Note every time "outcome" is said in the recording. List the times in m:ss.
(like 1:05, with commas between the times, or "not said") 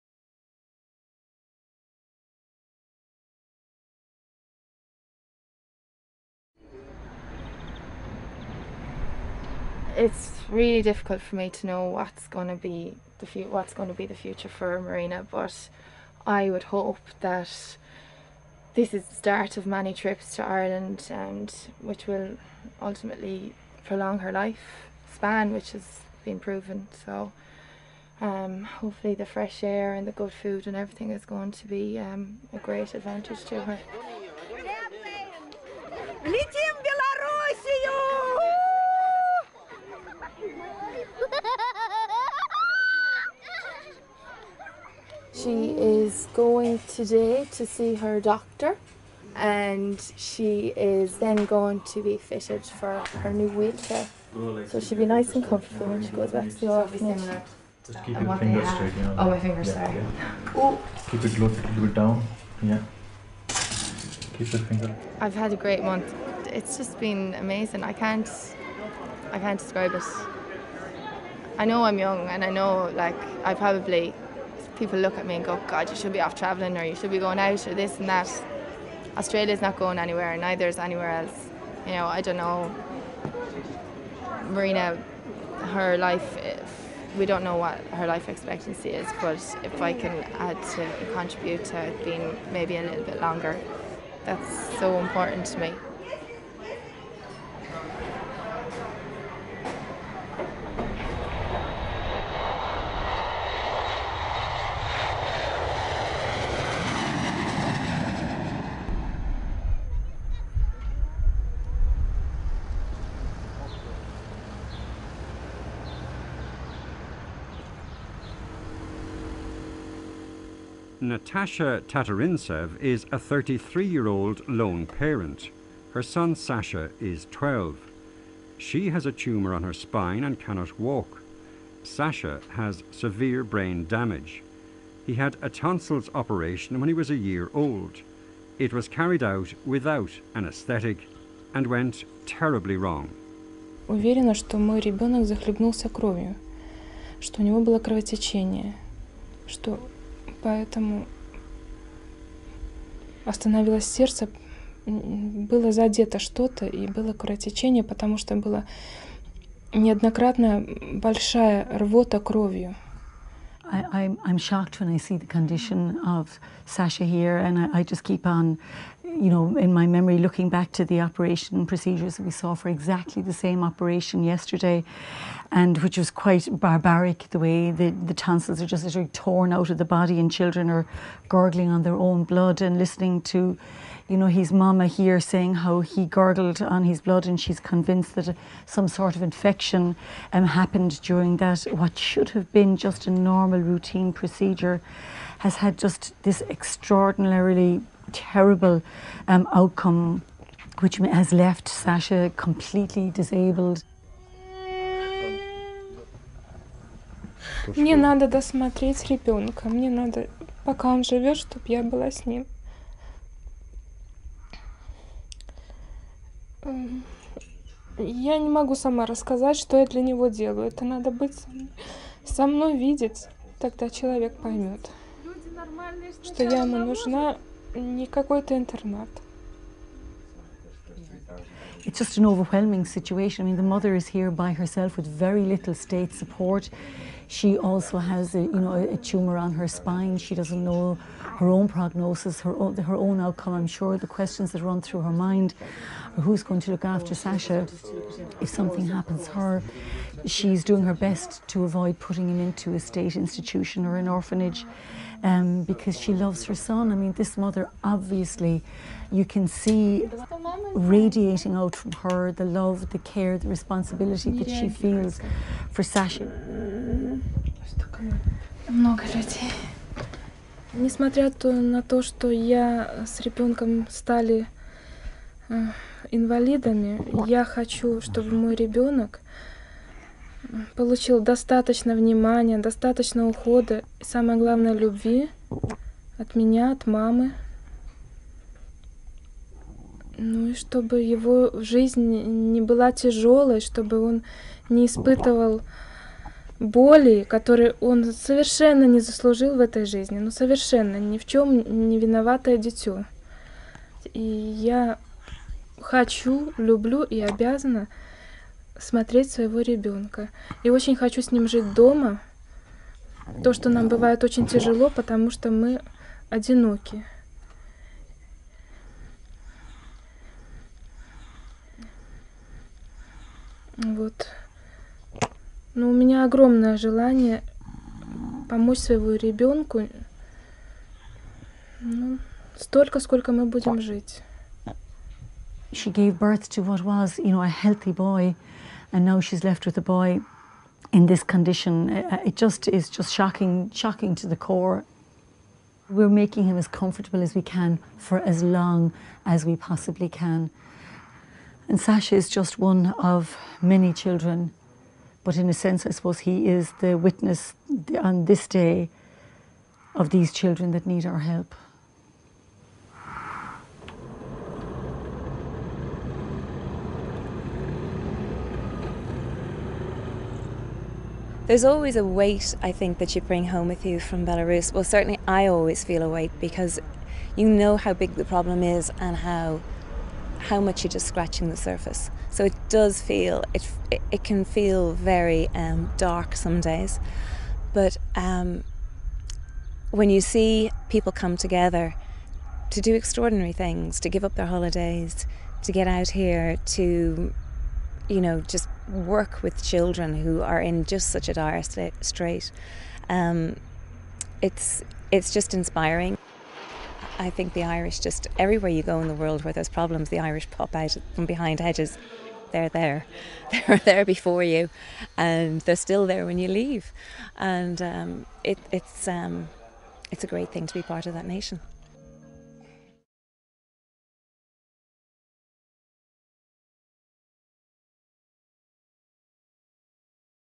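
3:19, 4:03.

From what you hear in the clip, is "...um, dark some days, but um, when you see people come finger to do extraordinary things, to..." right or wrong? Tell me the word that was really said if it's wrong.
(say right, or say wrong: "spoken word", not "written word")
wrong: "together", not "finger".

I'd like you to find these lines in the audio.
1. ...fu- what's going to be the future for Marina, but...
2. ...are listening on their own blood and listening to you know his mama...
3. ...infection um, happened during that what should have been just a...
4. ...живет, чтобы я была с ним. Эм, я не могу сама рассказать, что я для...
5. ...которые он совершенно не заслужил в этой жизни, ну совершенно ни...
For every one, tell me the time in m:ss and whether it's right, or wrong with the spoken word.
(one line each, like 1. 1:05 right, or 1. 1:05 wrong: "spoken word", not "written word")
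1. 0:13 right
2. 3:00 wrong: "gurgling", not "listening"
3. 3:09 right
4. 3:31 right
5. 4:57 right.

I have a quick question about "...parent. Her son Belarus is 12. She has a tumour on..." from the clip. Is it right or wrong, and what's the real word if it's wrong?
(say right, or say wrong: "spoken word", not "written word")
wrong: "Sasha", not "Belarus".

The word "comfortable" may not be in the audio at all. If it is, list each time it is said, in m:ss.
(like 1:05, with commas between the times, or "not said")
0:55, 5:46.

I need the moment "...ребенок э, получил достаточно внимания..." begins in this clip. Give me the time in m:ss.
4:38.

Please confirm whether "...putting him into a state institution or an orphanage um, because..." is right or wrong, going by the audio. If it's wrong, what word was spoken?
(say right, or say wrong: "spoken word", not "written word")
right.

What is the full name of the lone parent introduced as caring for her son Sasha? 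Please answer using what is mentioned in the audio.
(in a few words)
Natasha Tatarinsev.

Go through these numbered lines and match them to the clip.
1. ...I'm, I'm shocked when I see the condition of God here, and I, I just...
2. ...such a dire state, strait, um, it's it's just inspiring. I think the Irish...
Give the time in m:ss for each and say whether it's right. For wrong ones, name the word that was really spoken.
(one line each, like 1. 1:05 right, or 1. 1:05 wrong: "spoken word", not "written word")
1. 2:43 wrong: "Sasha", not "God"
2. 6:41 right.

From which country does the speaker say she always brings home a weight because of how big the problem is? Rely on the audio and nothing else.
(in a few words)
Belarus.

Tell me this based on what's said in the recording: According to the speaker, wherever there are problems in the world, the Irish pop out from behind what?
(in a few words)
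hedges.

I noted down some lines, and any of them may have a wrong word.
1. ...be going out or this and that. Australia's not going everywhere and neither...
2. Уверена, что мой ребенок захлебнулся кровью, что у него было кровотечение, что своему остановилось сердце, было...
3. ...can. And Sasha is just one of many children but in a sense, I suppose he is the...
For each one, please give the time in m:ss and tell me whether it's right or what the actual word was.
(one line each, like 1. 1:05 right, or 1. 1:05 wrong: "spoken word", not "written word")
1. 1:17 wrong: "anywhere", not "everywhere"
2. 2:23 wrong: "поэтому", not "своему"
3. 5:50 right.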